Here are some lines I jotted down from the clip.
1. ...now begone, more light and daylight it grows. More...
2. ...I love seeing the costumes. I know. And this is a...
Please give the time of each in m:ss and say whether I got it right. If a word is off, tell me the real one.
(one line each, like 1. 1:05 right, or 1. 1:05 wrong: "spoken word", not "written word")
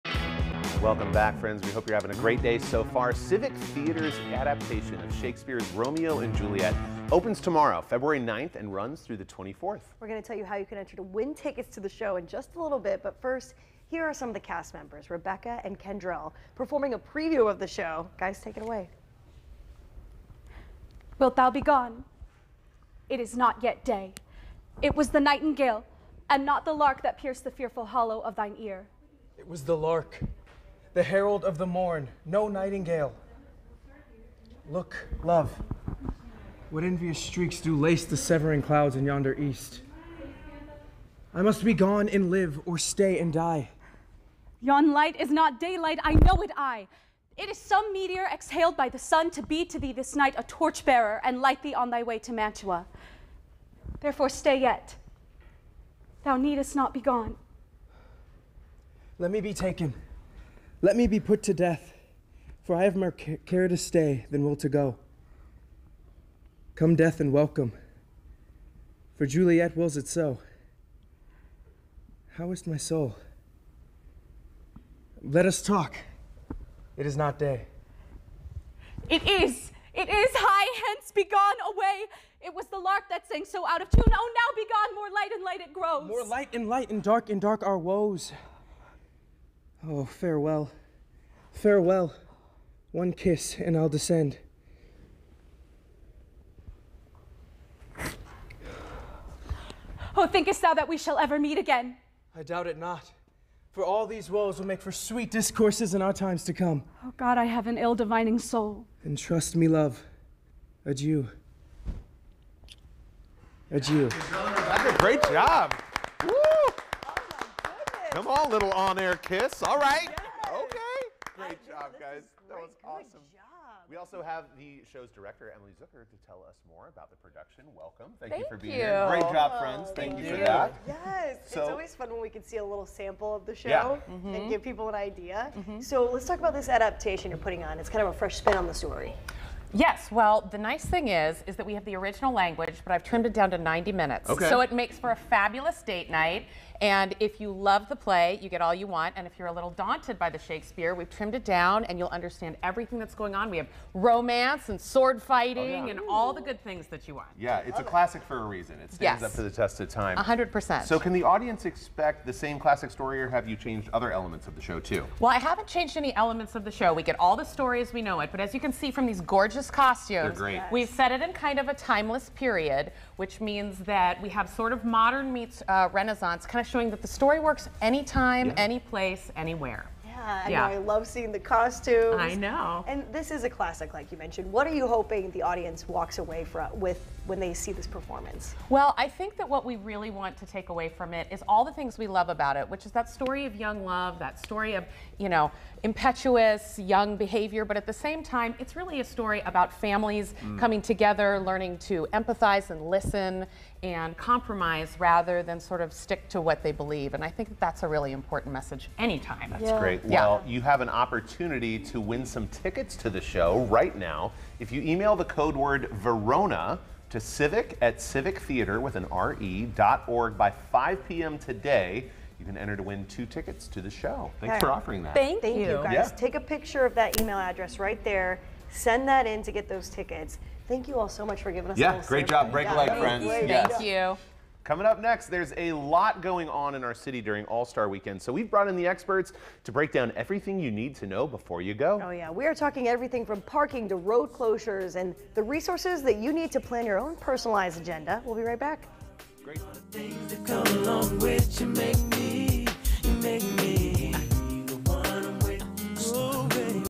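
1. 1:24 wrong: "light", not "daylight"
2. 3:00 right.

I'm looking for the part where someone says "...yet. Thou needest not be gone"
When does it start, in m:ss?
0:54.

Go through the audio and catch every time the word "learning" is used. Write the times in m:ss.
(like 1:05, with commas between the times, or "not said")
3:21.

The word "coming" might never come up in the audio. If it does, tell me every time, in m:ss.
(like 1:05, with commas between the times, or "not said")
3:20, 3:54.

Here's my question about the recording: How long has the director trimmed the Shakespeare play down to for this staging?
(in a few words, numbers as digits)
90 minutes.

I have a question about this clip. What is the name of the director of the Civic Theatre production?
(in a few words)
Emily Zucker.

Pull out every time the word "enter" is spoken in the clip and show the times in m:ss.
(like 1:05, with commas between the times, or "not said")
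0:10, 3:42.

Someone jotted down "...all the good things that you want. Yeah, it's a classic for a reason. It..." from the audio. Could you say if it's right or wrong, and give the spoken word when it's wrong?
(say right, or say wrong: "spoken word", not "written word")
right.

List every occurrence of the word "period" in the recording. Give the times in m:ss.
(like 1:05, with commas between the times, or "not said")
2:52.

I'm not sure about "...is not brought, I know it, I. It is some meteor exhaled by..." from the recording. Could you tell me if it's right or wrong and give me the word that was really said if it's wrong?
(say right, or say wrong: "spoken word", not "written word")
wrong: "daylight", not "brought".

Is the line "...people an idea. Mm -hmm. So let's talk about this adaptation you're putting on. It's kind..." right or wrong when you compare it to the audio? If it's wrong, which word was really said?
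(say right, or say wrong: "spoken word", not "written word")
right.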